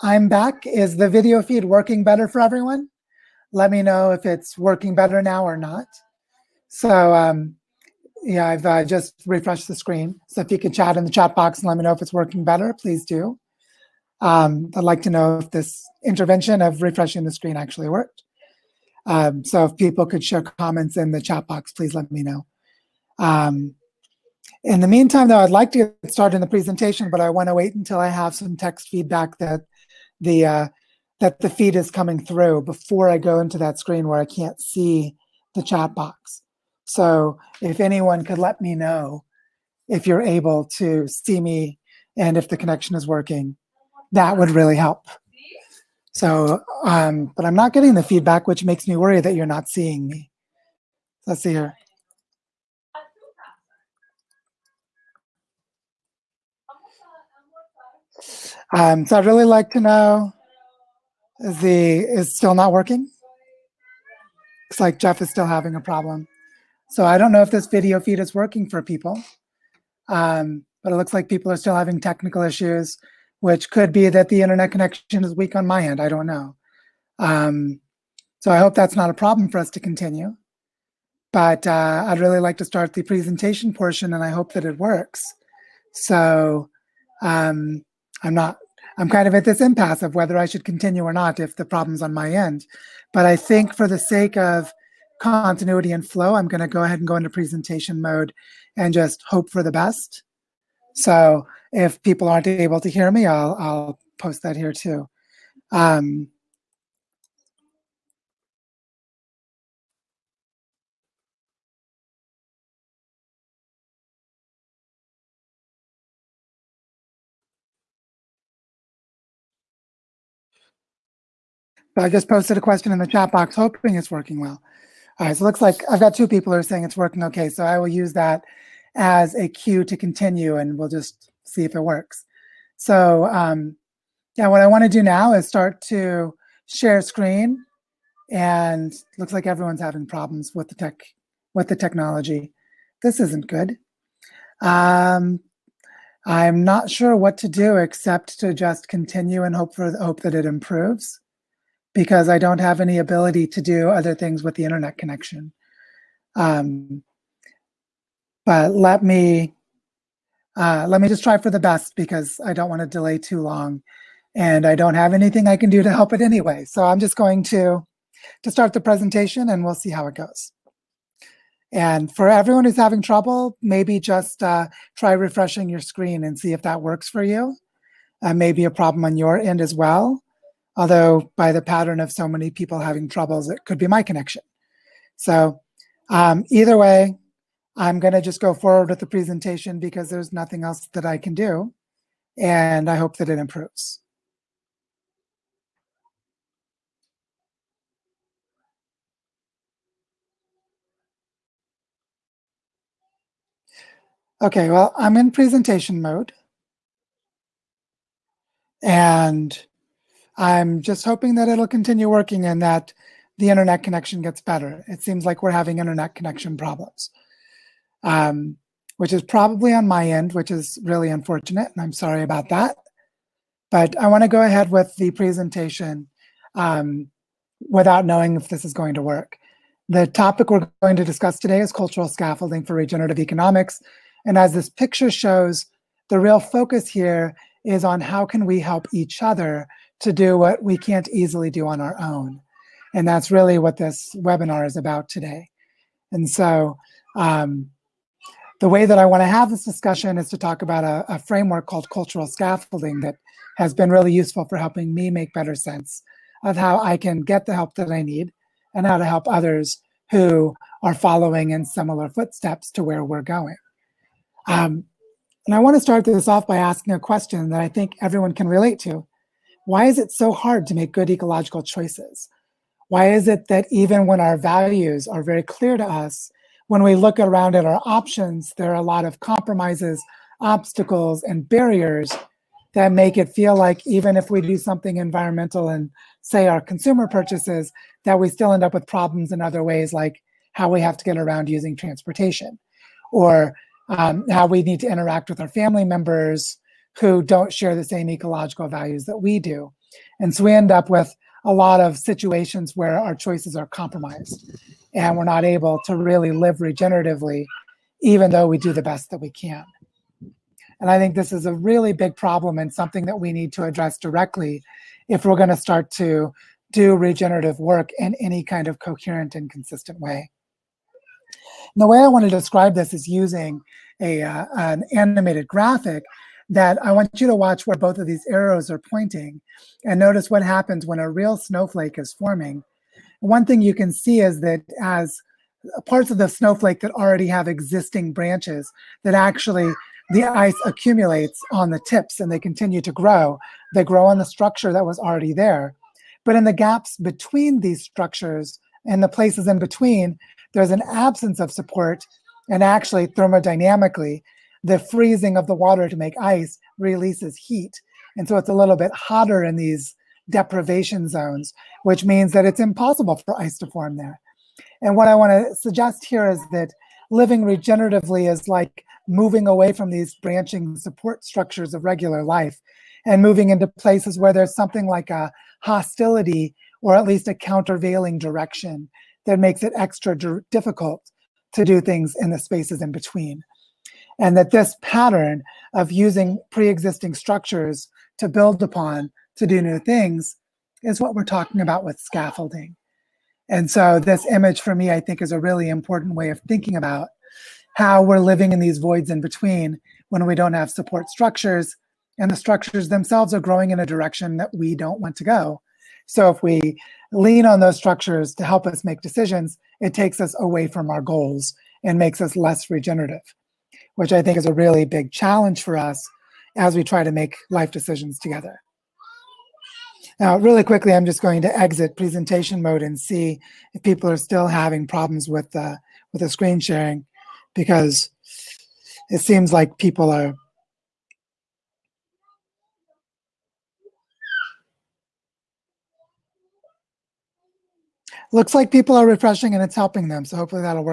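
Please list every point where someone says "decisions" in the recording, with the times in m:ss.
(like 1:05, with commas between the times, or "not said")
6:49, 6:57.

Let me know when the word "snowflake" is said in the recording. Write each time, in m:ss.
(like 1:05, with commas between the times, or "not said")
5:31, 5:36.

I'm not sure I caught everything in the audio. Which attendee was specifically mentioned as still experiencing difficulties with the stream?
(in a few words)
Jeff.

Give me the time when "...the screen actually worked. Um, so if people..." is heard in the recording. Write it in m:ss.
0:17.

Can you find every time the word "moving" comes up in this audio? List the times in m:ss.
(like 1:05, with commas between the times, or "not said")
6:09, 6:13.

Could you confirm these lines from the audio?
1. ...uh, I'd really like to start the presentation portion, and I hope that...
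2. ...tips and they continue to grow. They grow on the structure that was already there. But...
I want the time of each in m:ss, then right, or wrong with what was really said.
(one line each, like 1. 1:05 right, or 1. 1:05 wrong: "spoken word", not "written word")
1. 1:21 right
2. 5:41 right.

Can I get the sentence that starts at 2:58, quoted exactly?
Uh, maybe a problem on your end as well.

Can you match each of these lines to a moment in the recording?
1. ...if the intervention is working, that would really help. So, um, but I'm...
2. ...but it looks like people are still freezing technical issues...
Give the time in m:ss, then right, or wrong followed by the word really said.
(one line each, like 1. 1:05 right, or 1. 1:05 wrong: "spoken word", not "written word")
1. 0:42 wrong: "connection", not "intervention"
2. 1:10 wrong: "having", not "freezing".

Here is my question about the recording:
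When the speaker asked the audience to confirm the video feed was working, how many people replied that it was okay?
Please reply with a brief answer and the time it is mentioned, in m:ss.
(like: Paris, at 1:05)
2, at 2:06.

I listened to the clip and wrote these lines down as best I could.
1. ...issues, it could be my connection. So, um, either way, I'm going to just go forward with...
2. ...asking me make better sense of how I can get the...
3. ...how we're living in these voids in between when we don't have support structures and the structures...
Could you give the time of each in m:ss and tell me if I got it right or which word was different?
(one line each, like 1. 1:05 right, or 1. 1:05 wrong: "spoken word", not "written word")
1. 3:03 wrong: "troubles", not "issues"
2. 4:14 wrong: "helping", not "asking"
3. 6:37 right.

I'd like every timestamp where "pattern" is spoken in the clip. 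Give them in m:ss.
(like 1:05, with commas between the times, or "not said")
3:01, 6:24.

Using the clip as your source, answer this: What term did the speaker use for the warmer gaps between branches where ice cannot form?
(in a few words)
Deprivation zones.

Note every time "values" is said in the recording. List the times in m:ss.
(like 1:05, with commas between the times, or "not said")
4:34, 4:58.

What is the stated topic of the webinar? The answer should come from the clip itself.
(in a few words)
Cultural scaffolding for regenerative economics.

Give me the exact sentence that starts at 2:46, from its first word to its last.
So I'm just going to to start the presentation, and we'll see how it goes.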